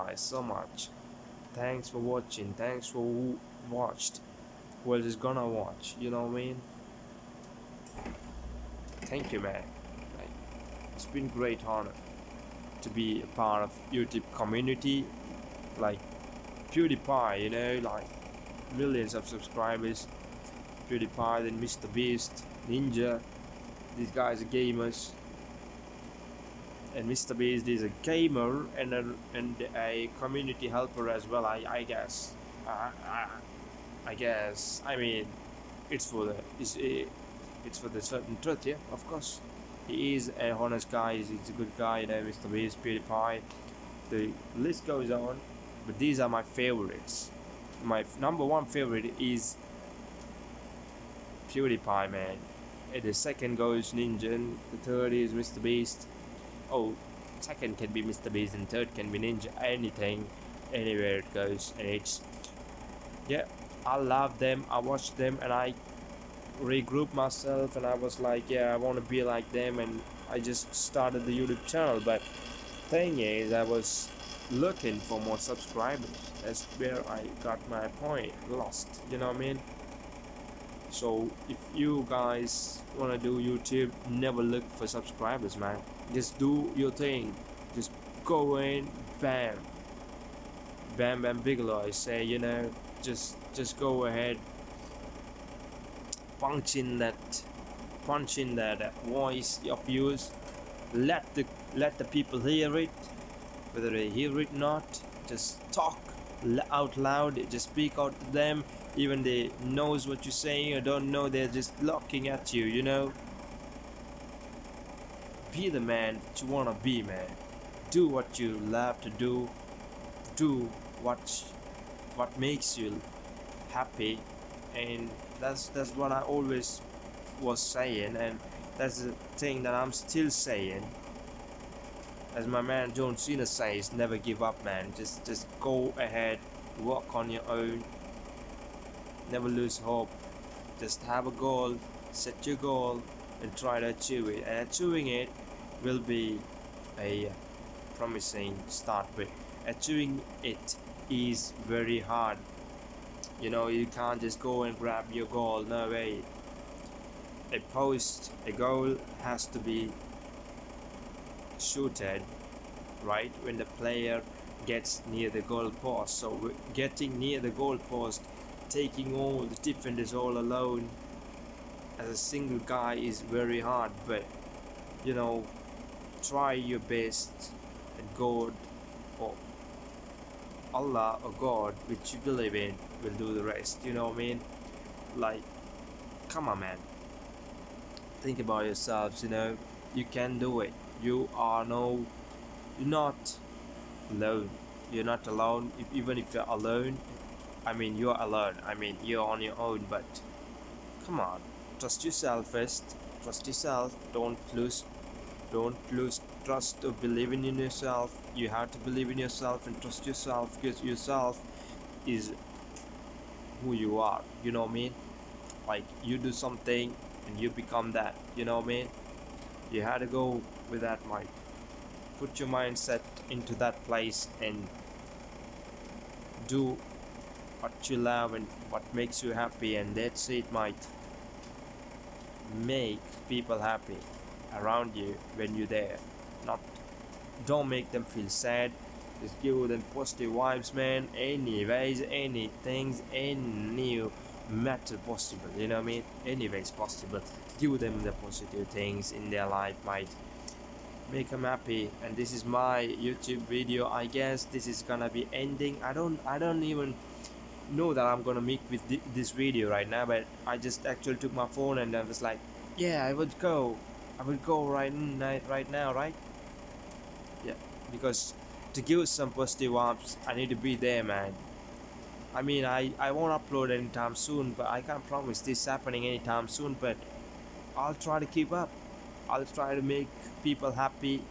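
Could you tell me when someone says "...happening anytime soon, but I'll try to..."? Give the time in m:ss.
4:35.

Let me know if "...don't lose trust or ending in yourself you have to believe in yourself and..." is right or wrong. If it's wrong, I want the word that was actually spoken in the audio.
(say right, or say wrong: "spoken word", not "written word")
wrong: "believing", not "ending".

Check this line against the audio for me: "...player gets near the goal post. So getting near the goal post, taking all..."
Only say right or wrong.
right.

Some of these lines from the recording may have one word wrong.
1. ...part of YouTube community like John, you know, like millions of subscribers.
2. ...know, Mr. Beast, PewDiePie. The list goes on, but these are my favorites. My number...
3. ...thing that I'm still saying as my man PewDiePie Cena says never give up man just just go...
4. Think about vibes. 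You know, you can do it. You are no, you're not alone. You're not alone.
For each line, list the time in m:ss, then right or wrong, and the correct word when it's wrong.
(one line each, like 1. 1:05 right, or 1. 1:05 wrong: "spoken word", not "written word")
1. 0:13 wrong: "PewDiePie", not "John"
2. 0:42 right
3. 2:09 wrong: "John", not "PewDiePie"
4. 3:08 wrong: "yourselves", not "vibes".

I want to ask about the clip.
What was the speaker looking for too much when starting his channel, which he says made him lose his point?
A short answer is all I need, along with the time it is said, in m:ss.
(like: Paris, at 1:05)
More subscribers, at 1:15.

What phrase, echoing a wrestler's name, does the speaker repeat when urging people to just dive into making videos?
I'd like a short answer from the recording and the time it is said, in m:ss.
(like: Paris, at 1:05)
bam bam bigelow, at 1:30.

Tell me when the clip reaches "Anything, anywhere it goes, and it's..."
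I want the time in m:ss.
0:59.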